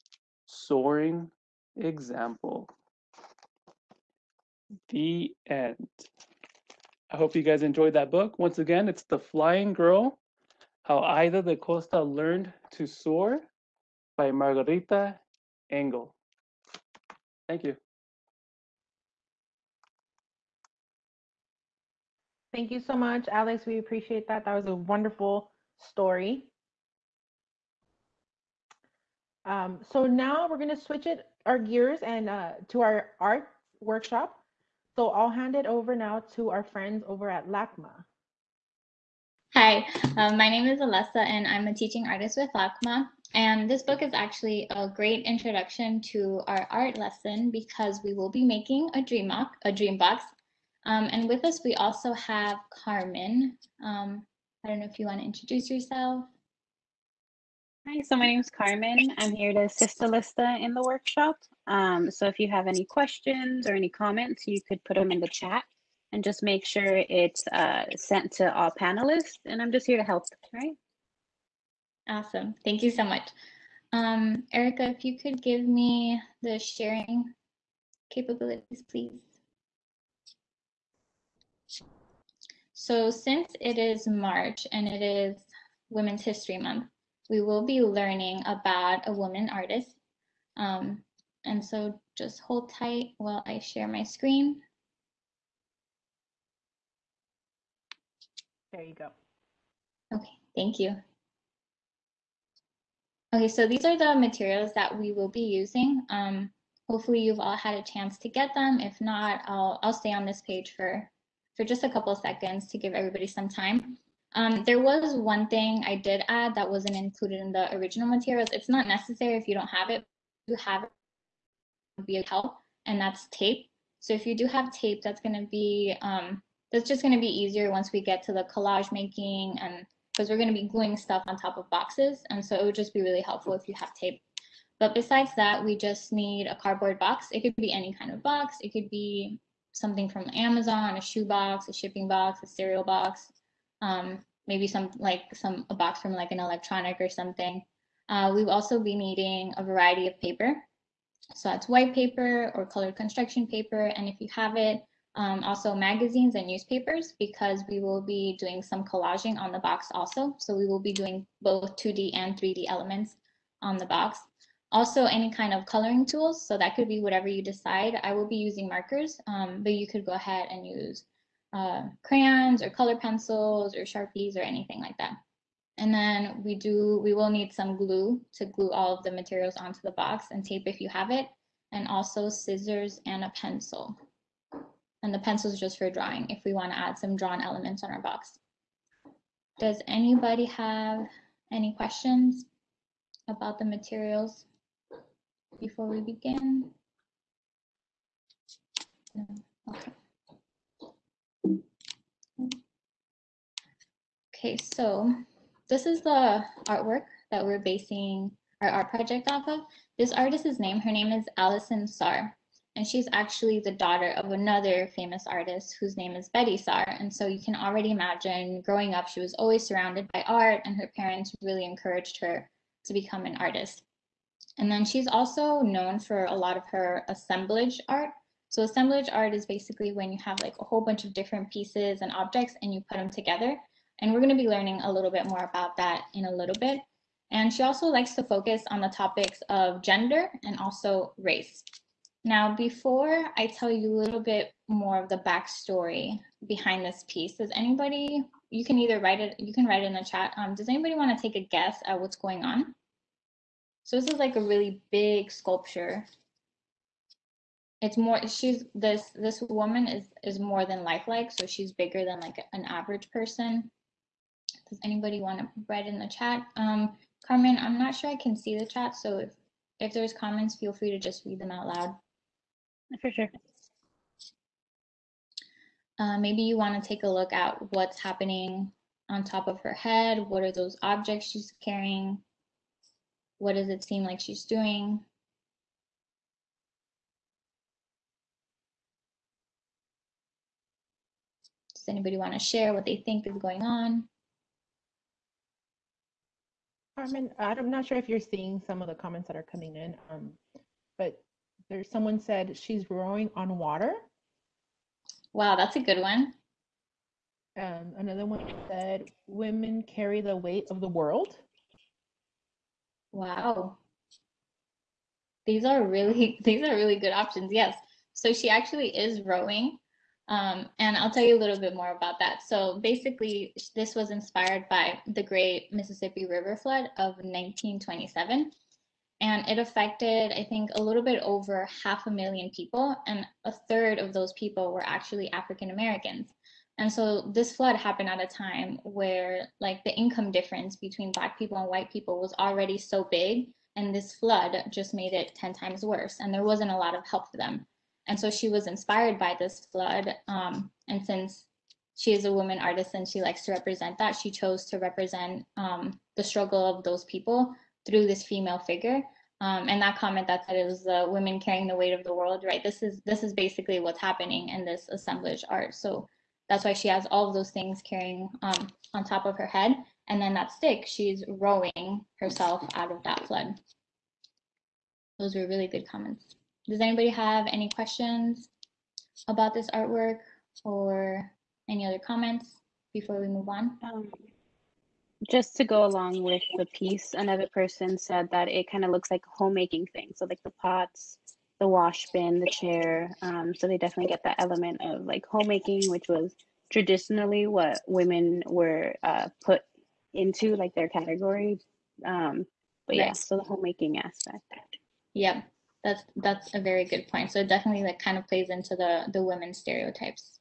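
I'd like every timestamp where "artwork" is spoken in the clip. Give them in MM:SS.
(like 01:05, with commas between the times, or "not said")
03:26, 06:19.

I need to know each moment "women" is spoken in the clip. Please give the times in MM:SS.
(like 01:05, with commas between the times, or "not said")
01:25, 05:09, 06:01, 06:37, 06:49.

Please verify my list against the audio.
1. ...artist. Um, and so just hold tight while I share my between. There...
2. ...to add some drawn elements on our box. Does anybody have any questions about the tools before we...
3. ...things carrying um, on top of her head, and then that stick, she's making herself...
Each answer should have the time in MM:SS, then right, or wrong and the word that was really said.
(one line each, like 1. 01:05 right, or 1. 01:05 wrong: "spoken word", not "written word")
1. 01:29 wrong: "screen", not "between"
2. 03:06 wrong: "materials", not "tools"
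3. 06:07 wrong: "rowing", not "making".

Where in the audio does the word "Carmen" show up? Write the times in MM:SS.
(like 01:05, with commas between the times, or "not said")
00:52, 00:58, 04:27, 04:56.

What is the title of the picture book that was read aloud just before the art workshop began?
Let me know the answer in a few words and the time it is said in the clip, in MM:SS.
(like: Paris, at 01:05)
The Flying Girl, at 00:09.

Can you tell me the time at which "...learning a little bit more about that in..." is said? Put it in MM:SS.
03:54.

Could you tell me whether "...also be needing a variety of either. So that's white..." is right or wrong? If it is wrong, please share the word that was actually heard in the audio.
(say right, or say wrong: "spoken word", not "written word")
wrong: "paper", not "either".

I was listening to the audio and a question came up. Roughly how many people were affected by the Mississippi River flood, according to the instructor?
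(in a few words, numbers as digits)
half a million.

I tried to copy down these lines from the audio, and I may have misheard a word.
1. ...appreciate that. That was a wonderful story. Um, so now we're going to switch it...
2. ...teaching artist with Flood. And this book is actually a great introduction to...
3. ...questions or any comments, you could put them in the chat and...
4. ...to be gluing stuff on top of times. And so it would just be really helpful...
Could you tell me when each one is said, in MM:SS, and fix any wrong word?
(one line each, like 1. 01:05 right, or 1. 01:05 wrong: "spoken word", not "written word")
1. 00:23 right
2. 00:41 wrong: "LACMA", not "Flood"
3. 01:02 right
4. 02:10 wrong: "boxes", not "times".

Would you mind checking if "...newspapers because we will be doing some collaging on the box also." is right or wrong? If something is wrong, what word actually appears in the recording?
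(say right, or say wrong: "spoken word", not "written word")
right.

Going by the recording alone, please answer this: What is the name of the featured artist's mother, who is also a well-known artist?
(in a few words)
Betye Saar.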